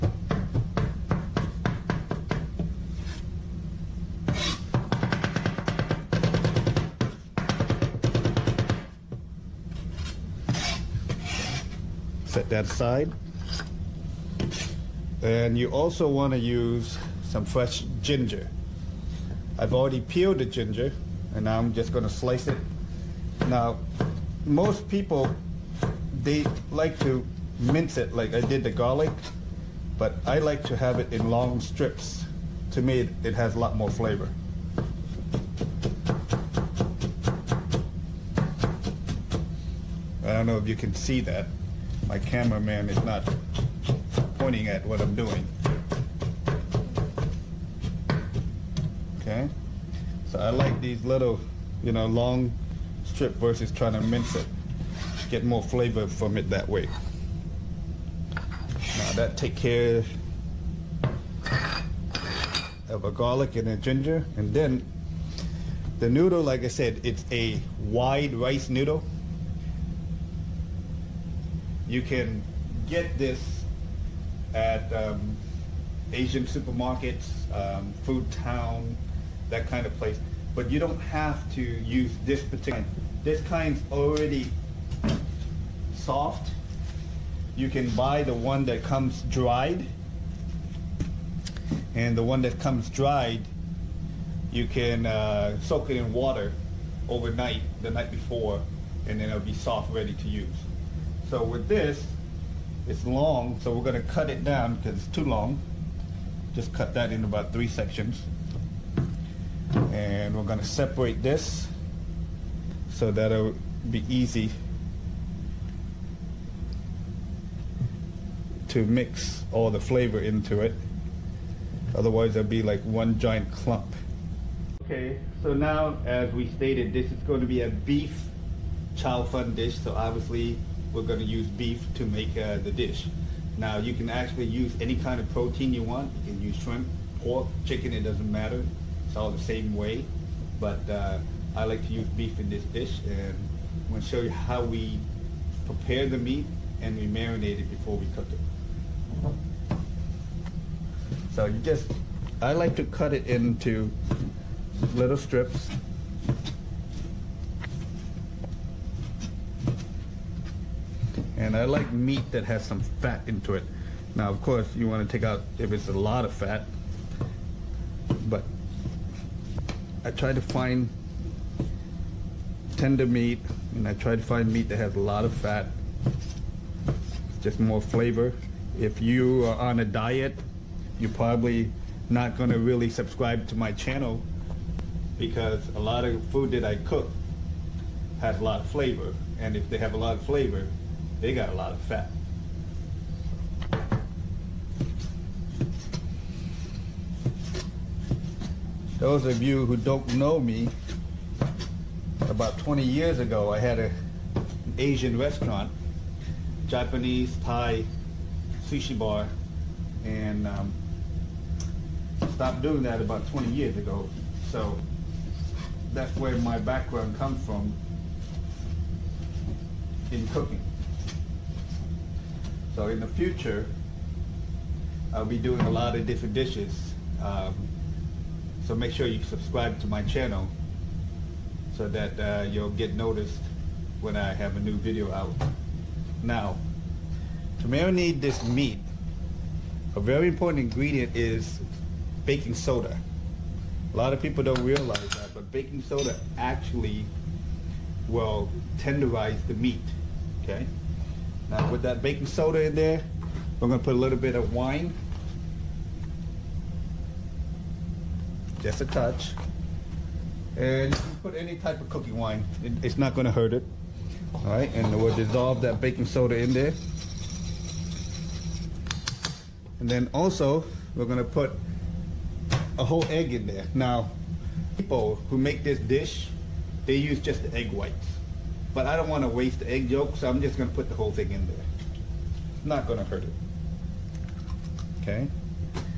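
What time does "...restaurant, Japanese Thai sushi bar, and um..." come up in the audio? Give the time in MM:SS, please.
03:25.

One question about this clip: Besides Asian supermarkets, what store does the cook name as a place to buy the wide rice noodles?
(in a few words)
Food Town.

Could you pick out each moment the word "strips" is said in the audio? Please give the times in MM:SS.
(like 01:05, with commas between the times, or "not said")
00:31, 00:53, 02:35.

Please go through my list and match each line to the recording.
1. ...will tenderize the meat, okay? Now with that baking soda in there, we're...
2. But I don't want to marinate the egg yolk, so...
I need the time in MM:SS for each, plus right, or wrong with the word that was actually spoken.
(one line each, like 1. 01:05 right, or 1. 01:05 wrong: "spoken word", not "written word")
1. 04:08 right
2. 04:38 wrong: "waste", not "marinate".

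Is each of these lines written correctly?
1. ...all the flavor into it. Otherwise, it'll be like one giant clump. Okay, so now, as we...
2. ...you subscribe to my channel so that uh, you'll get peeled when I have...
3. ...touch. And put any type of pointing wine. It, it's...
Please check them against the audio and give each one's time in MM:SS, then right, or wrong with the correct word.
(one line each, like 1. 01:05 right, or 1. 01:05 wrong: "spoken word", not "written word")
1. 01:59 right
2. 03:49 wrong: "noticed", not "peeled"
3. 04:18 wrong: "cooking", not "pointing".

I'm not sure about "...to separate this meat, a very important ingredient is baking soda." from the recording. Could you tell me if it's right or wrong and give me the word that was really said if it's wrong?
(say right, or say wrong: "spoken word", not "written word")
wrong: "marinate", not "separate".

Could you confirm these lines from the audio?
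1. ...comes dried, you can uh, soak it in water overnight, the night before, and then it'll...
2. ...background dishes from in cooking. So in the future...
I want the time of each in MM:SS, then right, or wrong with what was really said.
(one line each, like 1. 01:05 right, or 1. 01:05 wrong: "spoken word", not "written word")
1. 01:32 right
2. 03:36 wrong: "comes", not "dishes".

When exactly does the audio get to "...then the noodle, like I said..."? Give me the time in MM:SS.
01:04.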